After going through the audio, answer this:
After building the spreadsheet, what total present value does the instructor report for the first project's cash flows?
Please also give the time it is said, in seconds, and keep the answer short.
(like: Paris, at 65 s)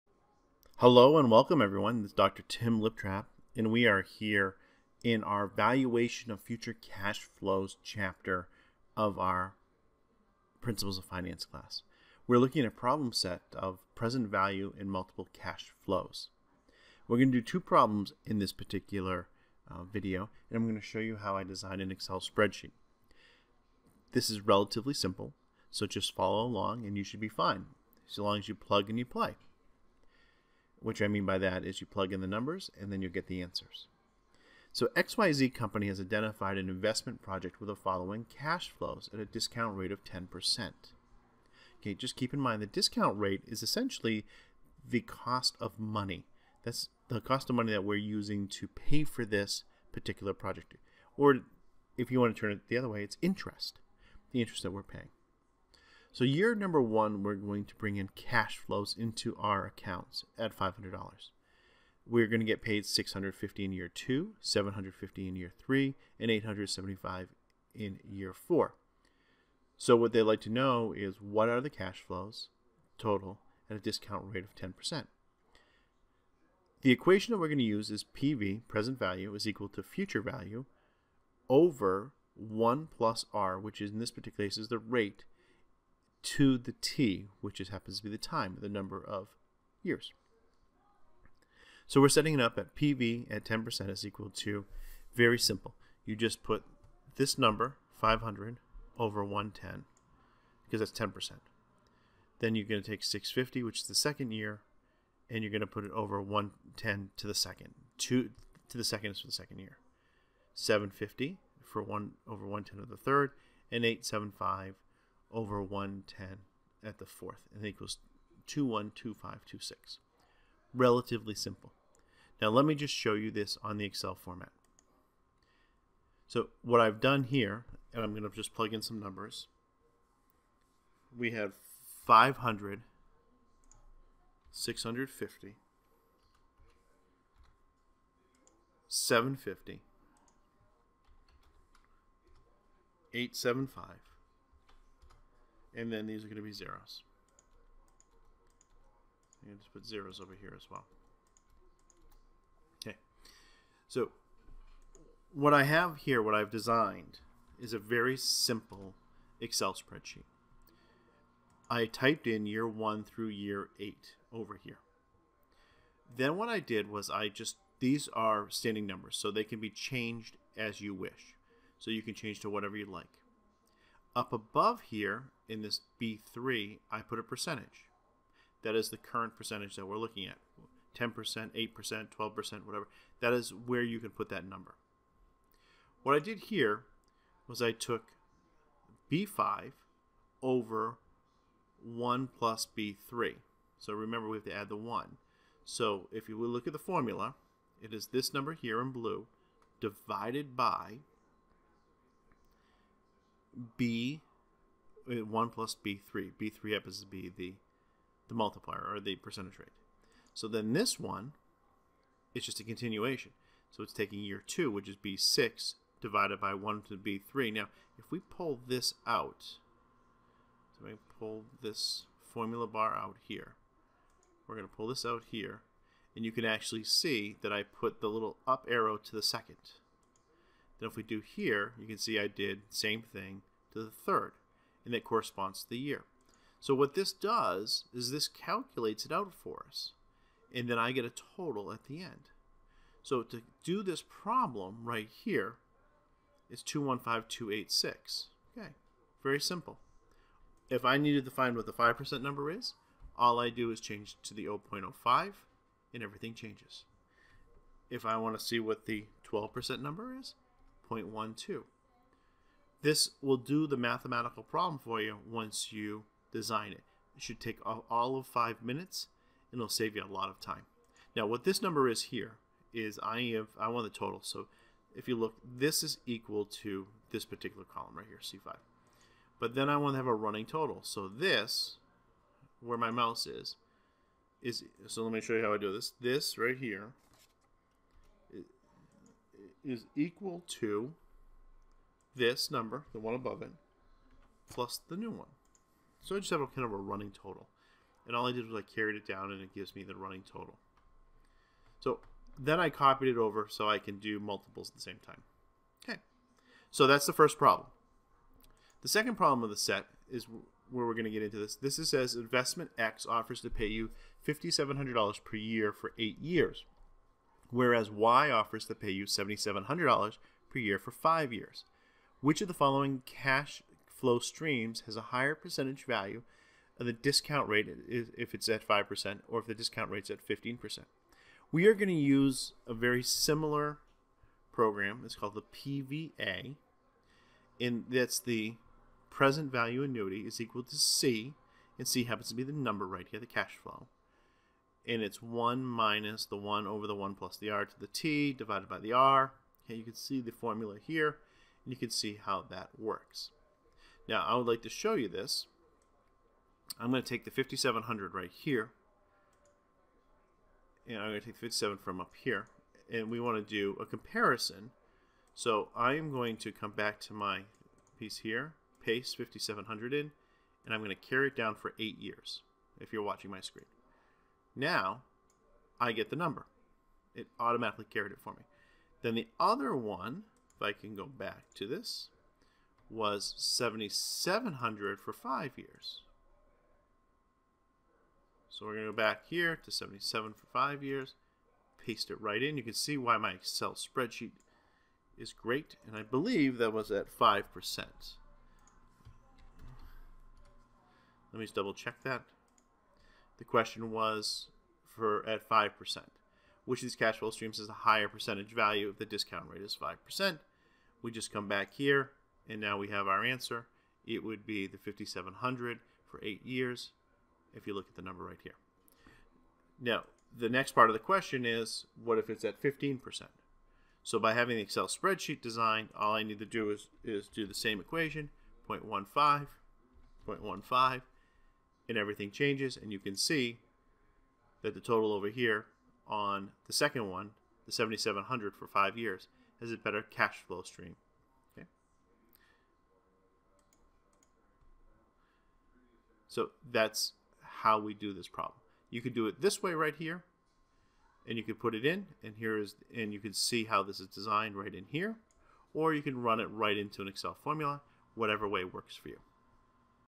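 215286, at 246 s.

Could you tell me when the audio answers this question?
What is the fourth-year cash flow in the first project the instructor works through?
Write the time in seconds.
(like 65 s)
66 s.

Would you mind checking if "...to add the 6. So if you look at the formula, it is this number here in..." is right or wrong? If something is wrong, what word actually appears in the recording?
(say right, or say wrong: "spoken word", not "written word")
wrong: "1", not "6".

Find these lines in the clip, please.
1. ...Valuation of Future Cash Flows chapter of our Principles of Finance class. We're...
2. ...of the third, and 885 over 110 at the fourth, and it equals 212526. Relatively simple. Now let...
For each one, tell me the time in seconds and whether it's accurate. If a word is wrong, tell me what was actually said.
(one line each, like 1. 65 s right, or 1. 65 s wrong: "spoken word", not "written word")
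1. 5 s right
2. 112 s wrong: "875", not "885".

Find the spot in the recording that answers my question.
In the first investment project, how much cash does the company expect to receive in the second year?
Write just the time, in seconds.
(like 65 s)
62 s.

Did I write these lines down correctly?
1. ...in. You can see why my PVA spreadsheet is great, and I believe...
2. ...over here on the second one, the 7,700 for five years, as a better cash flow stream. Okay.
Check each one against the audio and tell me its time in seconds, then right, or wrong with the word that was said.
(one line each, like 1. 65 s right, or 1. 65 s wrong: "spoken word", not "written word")
1. 392 s wrong: "Excel", not "PVA"
2. 435 s right.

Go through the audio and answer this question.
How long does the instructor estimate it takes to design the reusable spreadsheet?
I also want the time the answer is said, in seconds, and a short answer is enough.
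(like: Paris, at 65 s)
five minutes, at 268 s.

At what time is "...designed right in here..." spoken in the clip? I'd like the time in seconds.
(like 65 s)
454 s.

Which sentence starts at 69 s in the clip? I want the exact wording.
So what they'd like to know is what are the cash flows total at a discount rate of 10%.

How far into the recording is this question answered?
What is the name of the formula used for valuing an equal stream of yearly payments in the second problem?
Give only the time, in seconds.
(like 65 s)
335 s.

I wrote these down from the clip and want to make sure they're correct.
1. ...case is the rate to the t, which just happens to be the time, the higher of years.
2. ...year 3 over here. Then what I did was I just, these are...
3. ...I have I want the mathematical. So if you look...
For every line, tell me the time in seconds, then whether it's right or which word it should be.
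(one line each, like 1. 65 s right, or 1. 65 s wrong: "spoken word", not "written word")
1. 84 s wrong: "number", not "higher"
2. 163 s wrong: "8", not "3"
3. 273 s wrong: "total", not "mathematical".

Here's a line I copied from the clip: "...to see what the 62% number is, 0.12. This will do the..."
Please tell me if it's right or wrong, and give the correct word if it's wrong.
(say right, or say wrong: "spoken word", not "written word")
wrong: "12", not "62".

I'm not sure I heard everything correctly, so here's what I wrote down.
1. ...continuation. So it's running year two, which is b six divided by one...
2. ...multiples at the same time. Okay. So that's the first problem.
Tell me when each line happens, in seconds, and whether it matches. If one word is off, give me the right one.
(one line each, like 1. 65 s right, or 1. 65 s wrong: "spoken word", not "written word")
1. 212 s wrong: "taking", not "running"
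2. 304 s right.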